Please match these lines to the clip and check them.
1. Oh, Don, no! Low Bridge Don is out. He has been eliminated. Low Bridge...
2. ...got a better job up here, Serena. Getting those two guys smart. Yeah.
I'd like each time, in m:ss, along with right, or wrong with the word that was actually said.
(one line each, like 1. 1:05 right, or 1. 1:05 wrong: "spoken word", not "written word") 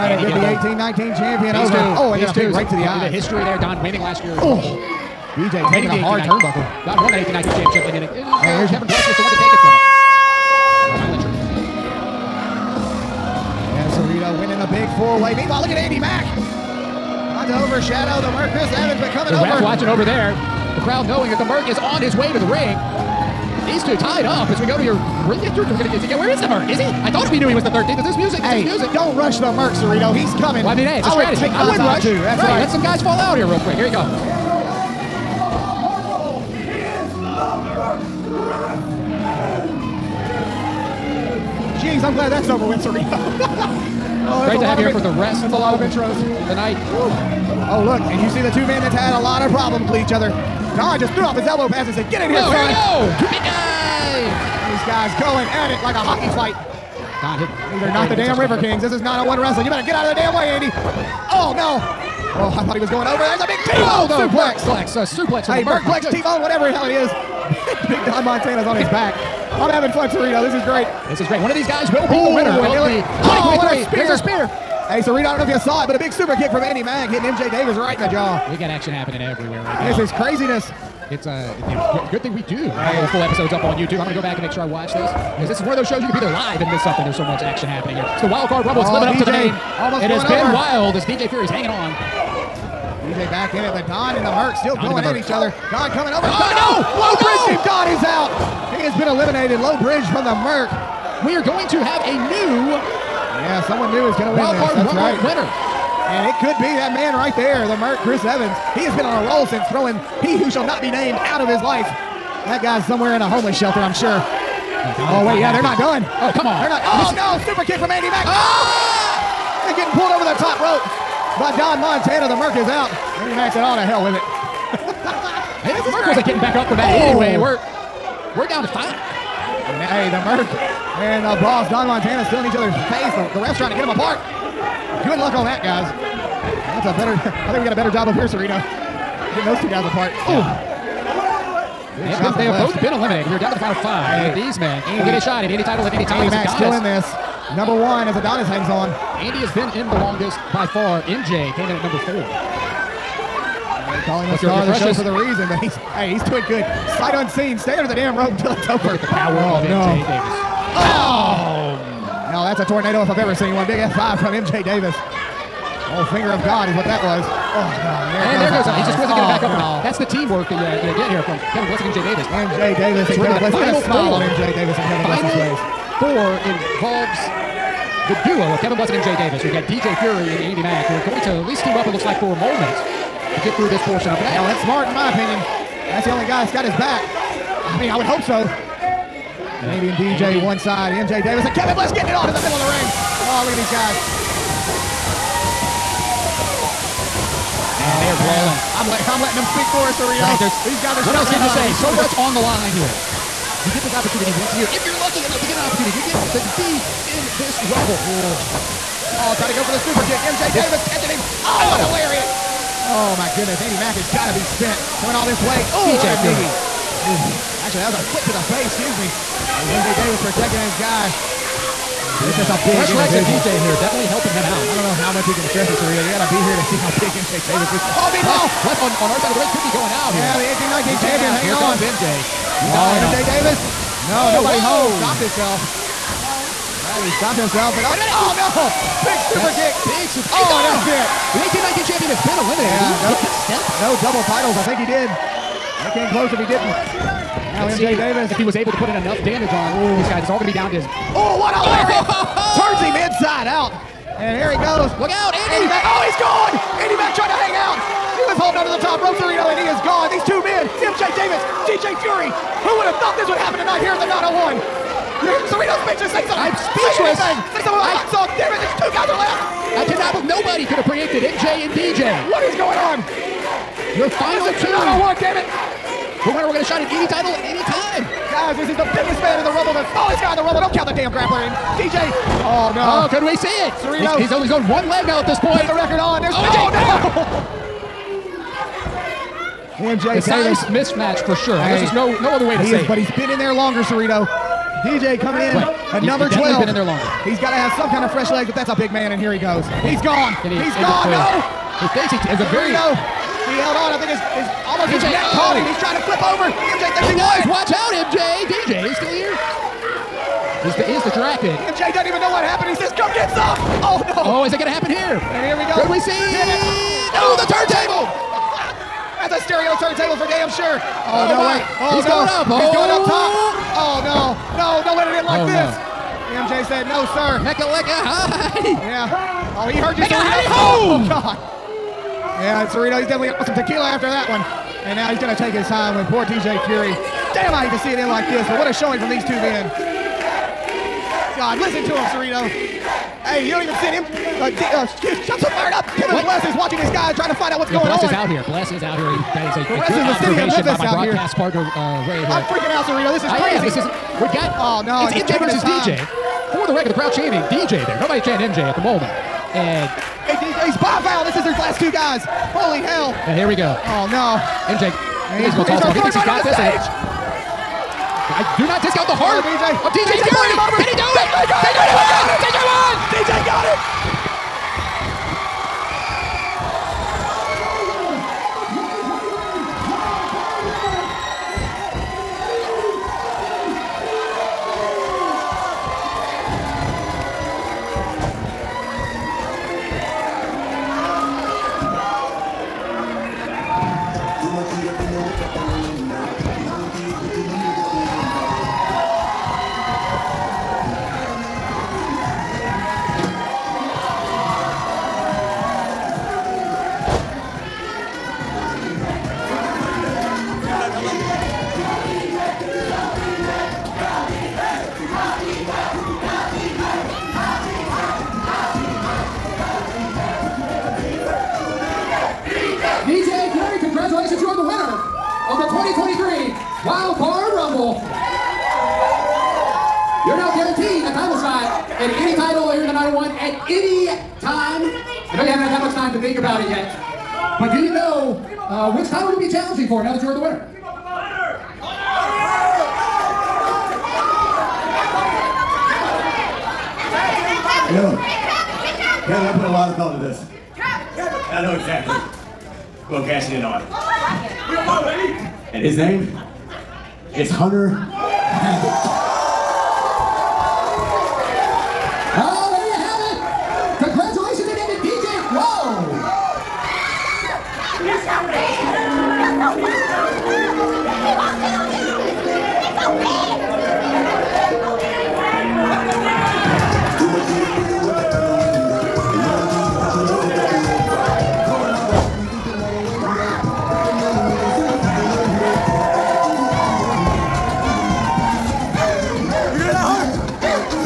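1. 1:36 right
2. 2:17 wrong: "apart", not "smart".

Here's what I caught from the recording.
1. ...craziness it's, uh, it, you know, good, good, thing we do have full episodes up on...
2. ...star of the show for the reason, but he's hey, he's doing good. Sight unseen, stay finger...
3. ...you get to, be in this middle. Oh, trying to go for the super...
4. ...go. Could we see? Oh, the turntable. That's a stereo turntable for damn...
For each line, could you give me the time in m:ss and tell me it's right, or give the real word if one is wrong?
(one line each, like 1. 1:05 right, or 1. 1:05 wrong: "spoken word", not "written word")
1. 1:20 right
2. 2:34 wrong: "under", not "finger"
3. 3:25 wrong: "rumble", not "middle"
4. 5:15 right.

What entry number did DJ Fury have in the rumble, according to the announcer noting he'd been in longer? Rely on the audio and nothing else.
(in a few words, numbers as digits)
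12.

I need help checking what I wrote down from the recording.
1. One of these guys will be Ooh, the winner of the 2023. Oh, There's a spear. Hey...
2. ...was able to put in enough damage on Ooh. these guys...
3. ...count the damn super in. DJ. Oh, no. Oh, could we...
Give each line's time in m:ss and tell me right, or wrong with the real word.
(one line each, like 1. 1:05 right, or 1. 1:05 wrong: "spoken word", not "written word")
1. 1:11 right
2. 4:08 right
3. 4:40 wrong: "grappler", not "super".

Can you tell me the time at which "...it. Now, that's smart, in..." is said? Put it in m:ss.
3:04.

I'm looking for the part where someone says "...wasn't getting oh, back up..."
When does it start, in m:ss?
2:48.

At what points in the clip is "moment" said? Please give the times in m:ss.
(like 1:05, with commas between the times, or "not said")
3:02, 5:58.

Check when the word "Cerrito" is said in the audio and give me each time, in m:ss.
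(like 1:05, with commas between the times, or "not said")
0:29, 3:19, 4:25, 4:53, 5:42.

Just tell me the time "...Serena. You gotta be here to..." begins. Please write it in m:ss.
3:45.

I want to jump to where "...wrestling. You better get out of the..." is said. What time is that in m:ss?
0:59.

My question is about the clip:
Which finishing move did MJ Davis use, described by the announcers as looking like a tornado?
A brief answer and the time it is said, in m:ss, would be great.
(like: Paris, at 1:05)
F5, at 2:43.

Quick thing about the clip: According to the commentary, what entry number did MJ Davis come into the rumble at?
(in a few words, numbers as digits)
4.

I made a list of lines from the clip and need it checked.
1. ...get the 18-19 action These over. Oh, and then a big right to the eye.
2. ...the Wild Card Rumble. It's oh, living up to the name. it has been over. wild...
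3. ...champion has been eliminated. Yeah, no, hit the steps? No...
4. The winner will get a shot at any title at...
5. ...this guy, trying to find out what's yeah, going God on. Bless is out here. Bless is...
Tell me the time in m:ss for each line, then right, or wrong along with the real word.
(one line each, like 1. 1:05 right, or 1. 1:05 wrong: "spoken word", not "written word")
1. 0:00 wrong: "champion", not "action"
2. 1:28 right
3. 4:01 right
4. 4:36 right
5. 5:46 wrong: "Bless", not "God".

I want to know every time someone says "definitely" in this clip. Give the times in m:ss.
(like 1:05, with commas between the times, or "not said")
3:43, 5:33.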